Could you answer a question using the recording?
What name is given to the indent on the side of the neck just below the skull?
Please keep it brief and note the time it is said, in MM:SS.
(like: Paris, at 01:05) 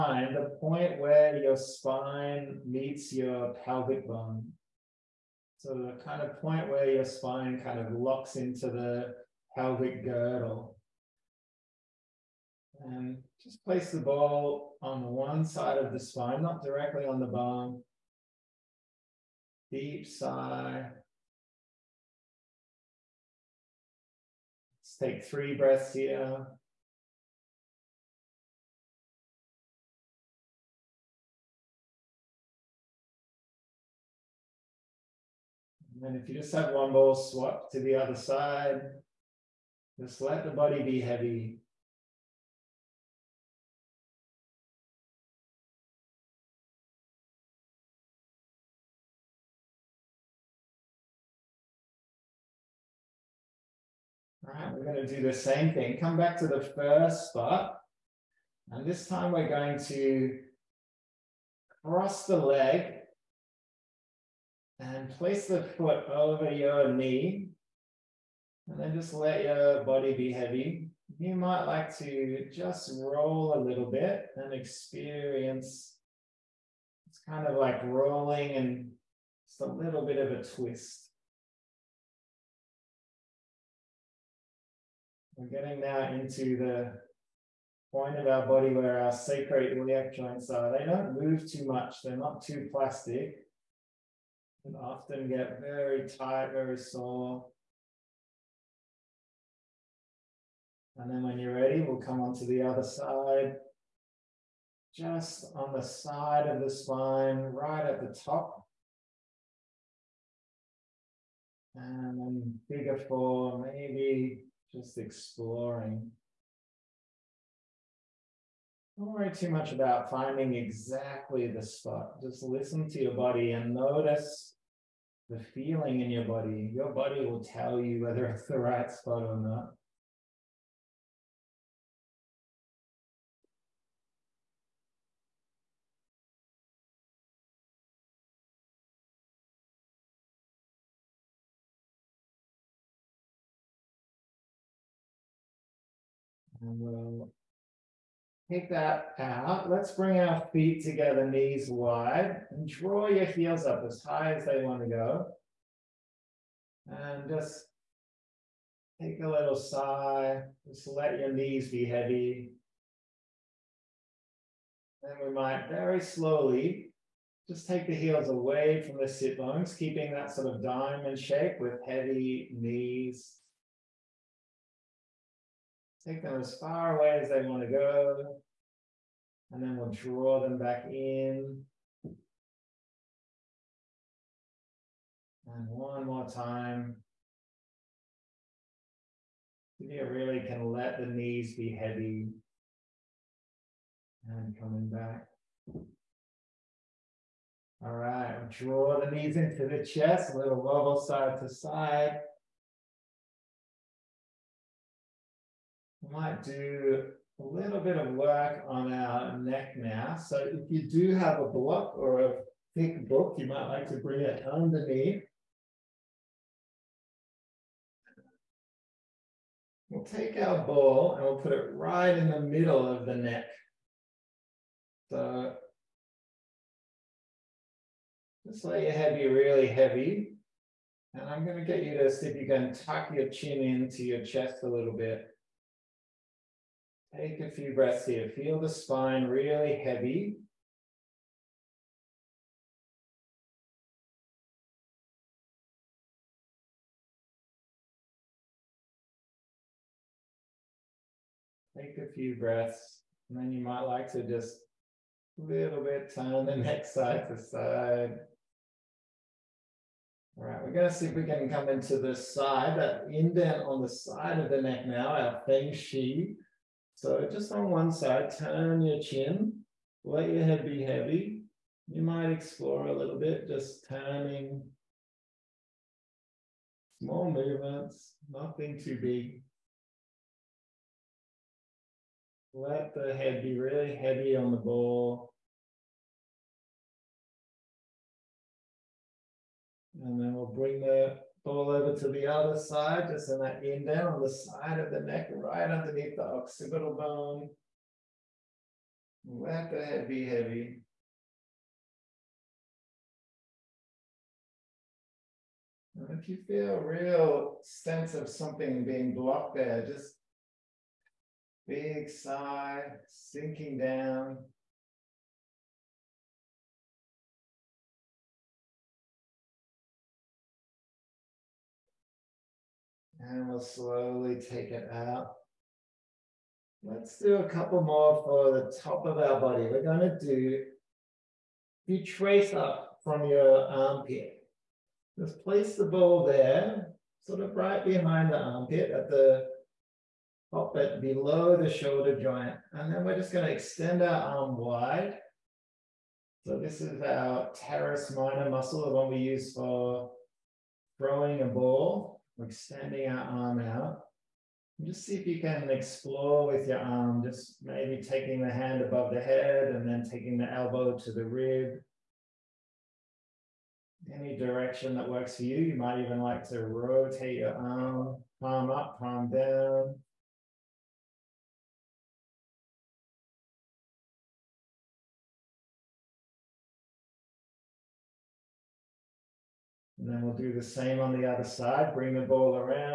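Feng Chi, at 04:25.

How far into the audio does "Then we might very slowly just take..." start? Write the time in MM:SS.
02:45.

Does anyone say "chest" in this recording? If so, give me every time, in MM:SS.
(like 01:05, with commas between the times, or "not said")
03:19, 03:54.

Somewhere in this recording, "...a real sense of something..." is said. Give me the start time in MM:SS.
05:06.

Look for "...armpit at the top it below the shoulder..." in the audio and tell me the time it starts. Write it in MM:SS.
05:38.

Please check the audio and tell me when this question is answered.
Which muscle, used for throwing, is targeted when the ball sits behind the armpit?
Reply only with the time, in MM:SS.
05:47.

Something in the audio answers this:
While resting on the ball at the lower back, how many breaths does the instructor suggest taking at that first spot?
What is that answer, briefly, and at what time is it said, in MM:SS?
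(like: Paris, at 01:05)
3, at 00:25.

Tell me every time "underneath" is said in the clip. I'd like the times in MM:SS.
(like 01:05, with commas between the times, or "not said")
03:34, 04:55.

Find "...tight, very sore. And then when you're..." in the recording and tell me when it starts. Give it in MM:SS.
01:36.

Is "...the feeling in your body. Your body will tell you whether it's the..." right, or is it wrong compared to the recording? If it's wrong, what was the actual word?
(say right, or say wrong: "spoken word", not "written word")
right.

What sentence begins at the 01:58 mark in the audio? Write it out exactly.
Don't worry too much about finding exactly the spot.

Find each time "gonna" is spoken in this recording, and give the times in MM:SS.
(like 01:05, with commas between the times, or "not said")
05:29, 05:43.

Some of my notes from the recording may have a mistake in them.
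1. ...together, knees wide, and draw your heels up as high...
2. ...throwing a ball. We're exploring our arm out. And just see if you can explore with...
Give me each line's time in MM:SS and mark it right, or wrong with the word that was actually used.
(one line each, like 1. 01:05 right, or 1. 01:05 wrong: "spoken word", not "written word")
1. 02:30 right
2. 05:50 wrong: "extending", not "exploring".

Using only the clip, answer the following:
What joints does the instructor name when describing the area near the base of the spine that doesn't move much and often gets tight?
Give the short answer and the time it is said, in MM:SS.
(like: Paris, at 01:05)
sacroiliac joints, at 01:29.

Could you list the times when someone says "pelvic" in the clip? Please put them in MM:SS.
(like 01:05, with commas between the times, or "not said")
00:03, 00:09.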